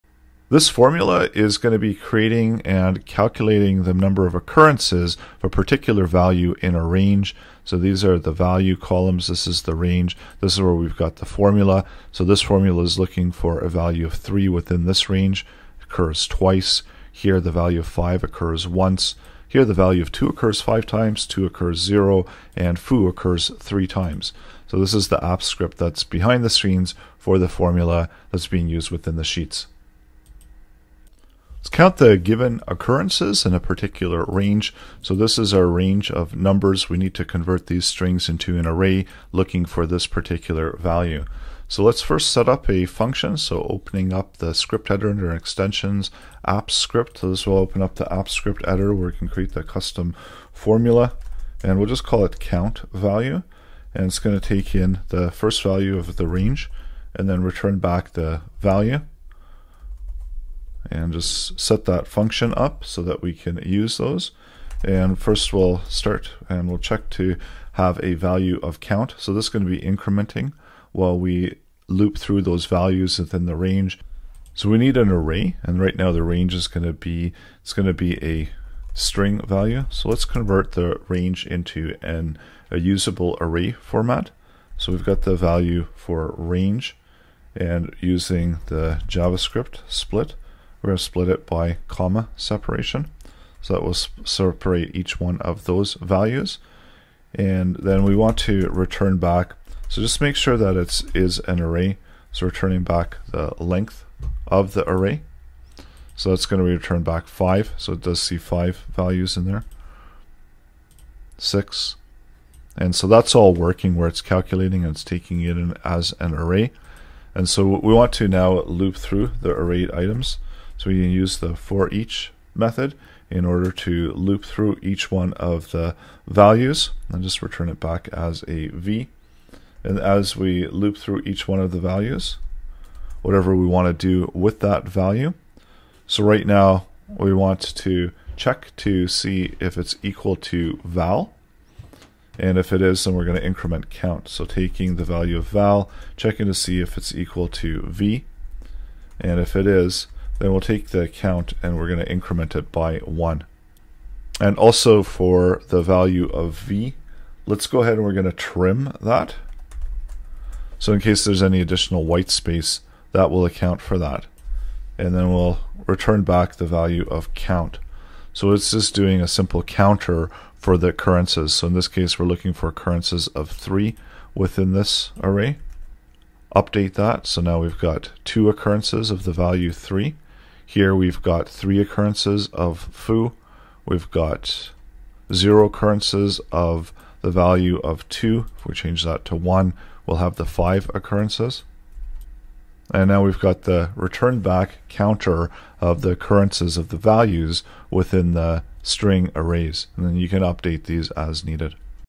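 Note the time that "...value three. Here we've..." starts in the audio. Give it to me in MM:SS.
02:59.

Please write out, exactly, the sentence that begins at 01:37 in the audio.
And then we want to return back.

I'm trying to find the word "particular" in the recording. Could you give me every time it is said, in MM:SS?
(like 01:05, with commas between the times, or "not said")
00:05, 00:33, 00:40.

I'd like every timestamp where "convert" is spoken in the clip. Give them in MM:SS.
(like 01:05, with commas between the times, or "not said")
00:37, 01:20.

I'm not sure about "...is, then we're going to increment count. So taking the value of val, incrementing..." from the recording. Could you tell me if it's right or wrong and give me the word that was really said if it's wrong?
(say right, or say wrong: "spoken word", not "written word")
wrong: "checking", not "incrementing".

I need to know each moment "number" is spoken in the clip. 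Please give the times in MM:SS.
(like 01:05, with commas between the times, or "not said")
00:03, 00:36.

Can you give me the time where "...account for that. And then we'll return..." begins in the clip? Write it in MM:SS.
02:43.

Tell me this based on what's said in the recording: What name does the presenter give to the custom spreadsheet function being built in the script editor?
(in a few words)
count value.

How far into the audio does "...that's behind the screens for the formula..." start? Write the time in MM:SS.
00:25.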